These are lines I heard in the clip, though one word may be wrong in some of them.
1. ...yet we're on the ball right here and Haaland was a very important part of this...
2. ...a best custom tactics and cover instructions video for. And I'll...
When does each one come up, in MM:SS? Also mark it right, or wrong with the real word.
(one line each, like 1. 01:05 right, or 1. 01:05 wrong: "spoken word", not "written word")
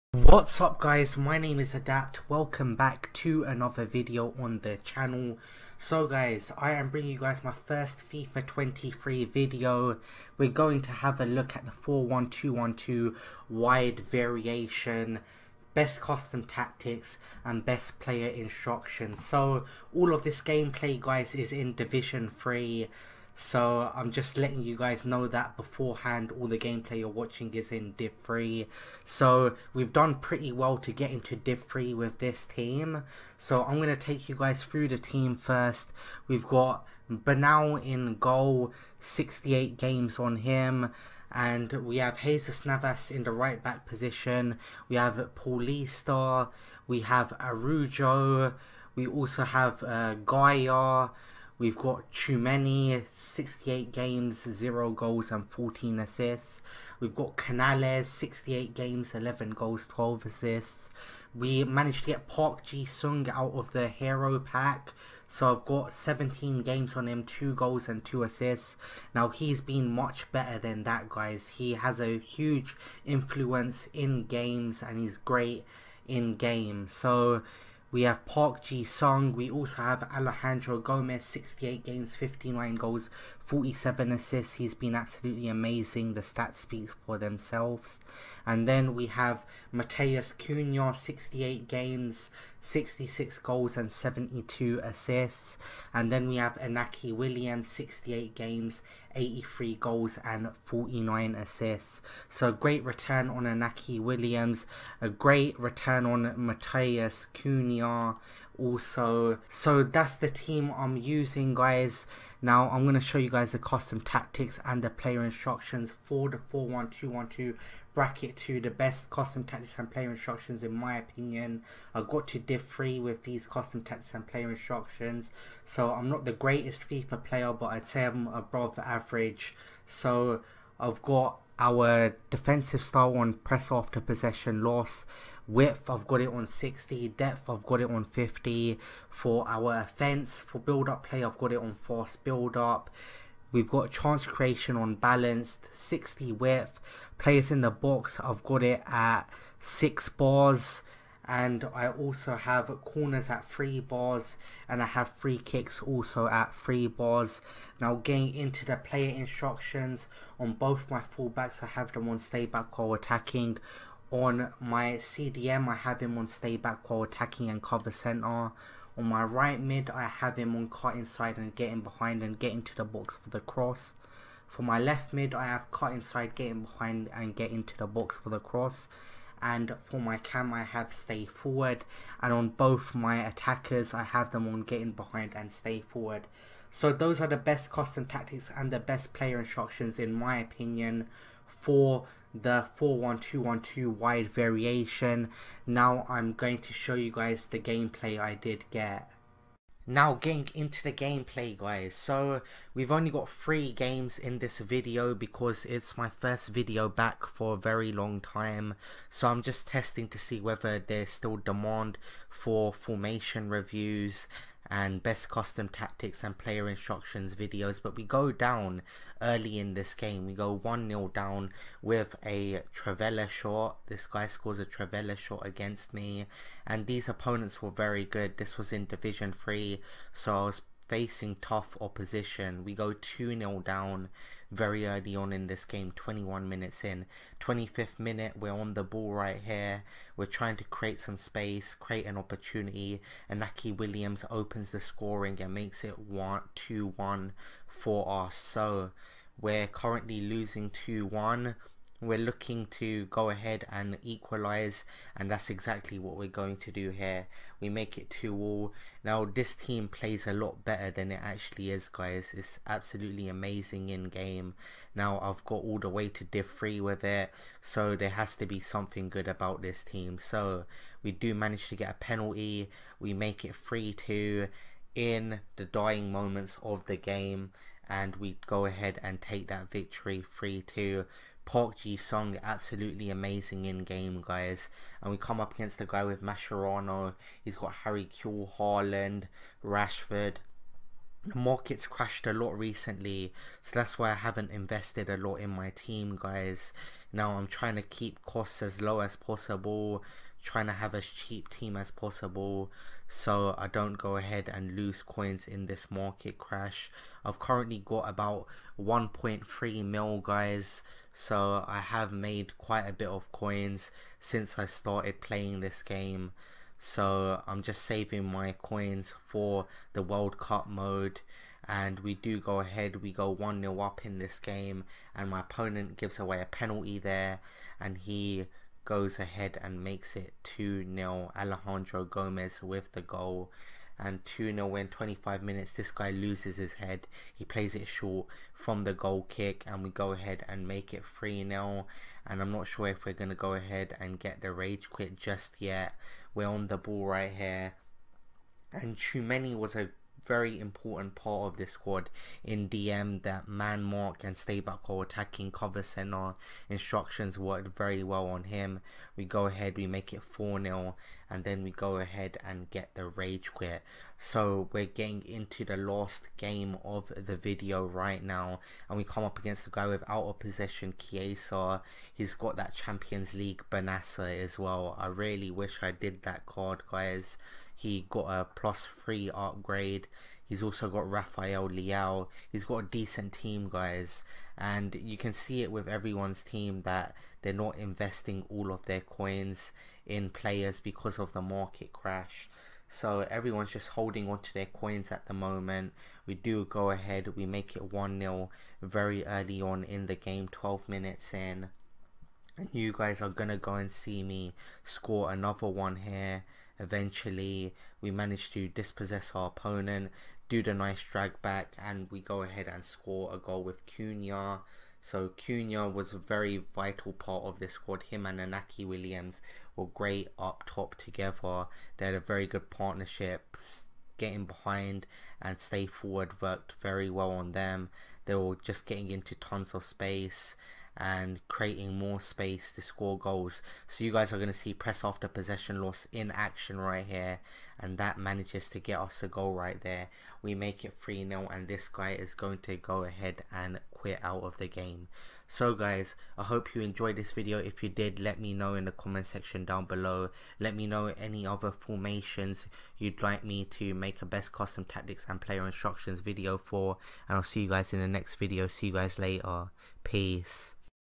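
1. 05:45 wrong: "Tchouaméni", not "Haaland"
2. 07:34 wrong: "player", not "cover".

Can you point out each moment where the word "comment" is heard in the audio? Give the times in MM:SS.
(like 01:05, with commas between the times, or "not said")
07:28.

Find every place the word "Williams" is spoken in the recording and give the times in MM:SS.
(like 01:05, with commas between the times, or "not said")
01:37, 01:43, 04:03, 06:58.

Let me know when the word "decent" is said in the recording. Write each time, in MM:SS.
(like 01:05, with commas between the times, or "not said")
06:22.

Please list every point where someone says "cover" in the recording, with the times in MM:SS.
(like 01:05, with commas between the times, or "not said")
02:47, 05:55.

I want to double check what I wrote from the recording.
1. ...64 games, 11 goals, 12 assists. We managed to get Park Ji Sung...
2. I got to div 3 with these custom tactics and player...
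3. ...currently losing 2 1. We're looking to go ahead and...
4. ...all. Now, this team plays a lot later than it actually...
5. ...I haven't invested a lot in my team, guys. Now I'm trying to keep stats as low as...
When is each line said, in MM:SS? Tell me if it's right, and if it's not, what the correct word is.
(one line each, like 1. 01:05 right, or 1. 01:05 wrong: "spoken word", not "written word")
1. 00:58 wrong: "68", not "64"
2. 02:01 right
3. 04:09 right
4. 04:18 wrong: "better", not "later"
5. 04:54 wrong: "costs", not "stats".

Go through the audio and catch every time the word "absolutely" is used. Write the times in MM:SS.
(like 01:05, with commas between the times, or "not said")
01:24, 04:22, 04:42.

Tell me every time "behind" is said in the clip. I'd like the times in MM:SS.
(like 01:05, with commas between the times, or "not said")
02:51, 02:56, 03:04, 07:04.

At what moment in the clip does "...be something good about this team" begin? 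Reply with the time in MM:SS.
04:28.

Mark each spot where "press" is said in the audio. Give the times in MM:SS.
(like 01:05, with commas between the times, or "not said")
02:13, 07:14.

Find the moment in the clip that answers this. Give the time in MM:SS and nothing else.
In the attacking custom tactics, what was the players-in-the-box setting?
02:29.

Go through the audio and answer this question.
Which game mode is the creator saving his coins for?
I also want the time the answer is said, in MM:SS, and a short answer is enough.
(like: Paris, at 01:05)
World Cup mode, at 05:20.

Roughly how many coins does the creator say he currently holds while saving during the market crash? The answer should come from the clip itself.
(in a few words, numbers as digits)
1.3 million.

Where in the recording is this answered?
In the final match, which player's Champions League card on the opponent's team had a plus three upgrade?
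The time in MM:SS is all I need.
06:13.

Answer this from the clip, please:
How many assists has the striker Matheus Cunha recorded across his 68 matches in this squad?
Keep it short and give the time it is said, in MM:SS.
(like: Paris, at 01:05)
72, at 01:33.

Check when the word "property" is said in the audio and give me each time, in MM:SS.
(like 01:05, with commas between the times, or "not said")
not said.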